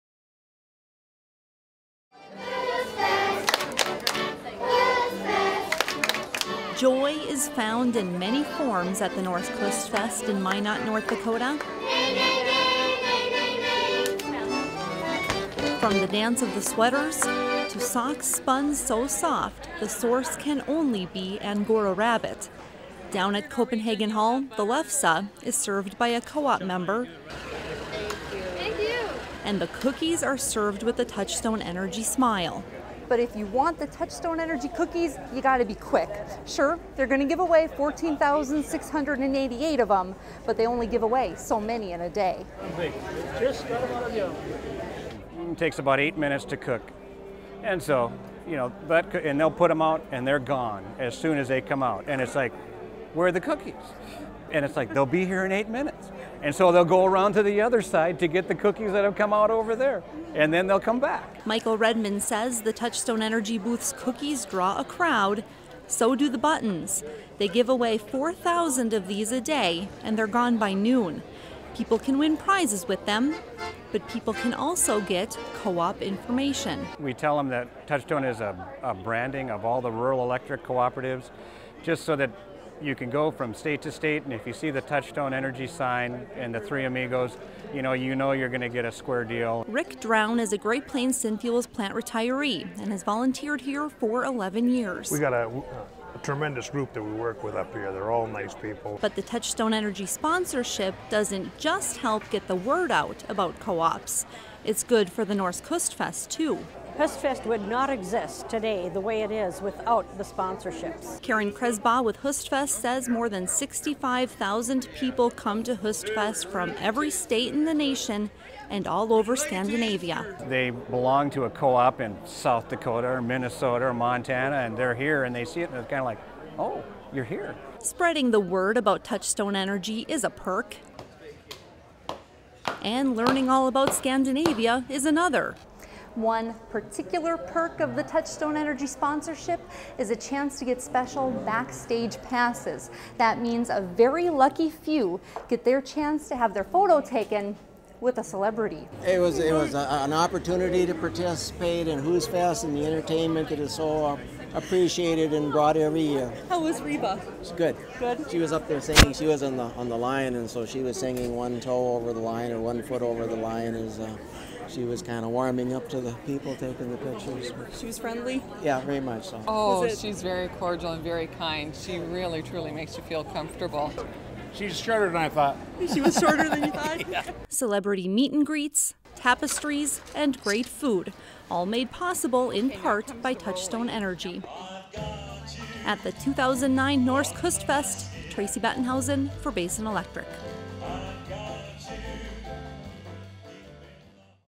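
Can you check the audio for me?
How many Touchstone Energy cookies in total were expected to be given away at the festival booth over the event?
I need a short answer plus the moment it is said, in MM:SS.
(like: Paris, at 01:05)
14,688, at 00:37.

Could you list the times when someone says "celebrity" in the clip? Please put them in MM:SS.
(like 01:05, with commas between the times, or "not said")
02:28, 02:57.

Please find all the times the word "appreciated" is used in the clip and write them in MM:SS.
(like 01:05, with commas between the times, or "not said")
02:34.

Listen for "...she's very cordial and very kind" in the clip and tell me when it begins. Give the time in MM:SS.
02:49.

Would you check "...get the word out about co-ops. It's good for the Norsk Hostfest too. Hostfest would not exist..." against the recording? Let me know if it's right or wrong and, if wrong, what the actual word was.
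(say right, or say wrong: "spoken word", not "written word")
right.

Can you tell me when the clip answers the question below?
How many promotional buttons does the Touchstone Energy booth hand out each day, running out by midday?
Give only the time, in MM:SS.
01:07.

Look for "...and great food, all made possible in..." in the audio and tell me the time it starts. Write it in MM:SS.
03:00.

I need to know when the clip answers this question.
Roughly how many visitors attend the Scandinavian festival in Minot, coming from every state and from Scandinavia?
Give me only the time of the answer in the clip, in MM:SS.
01:53.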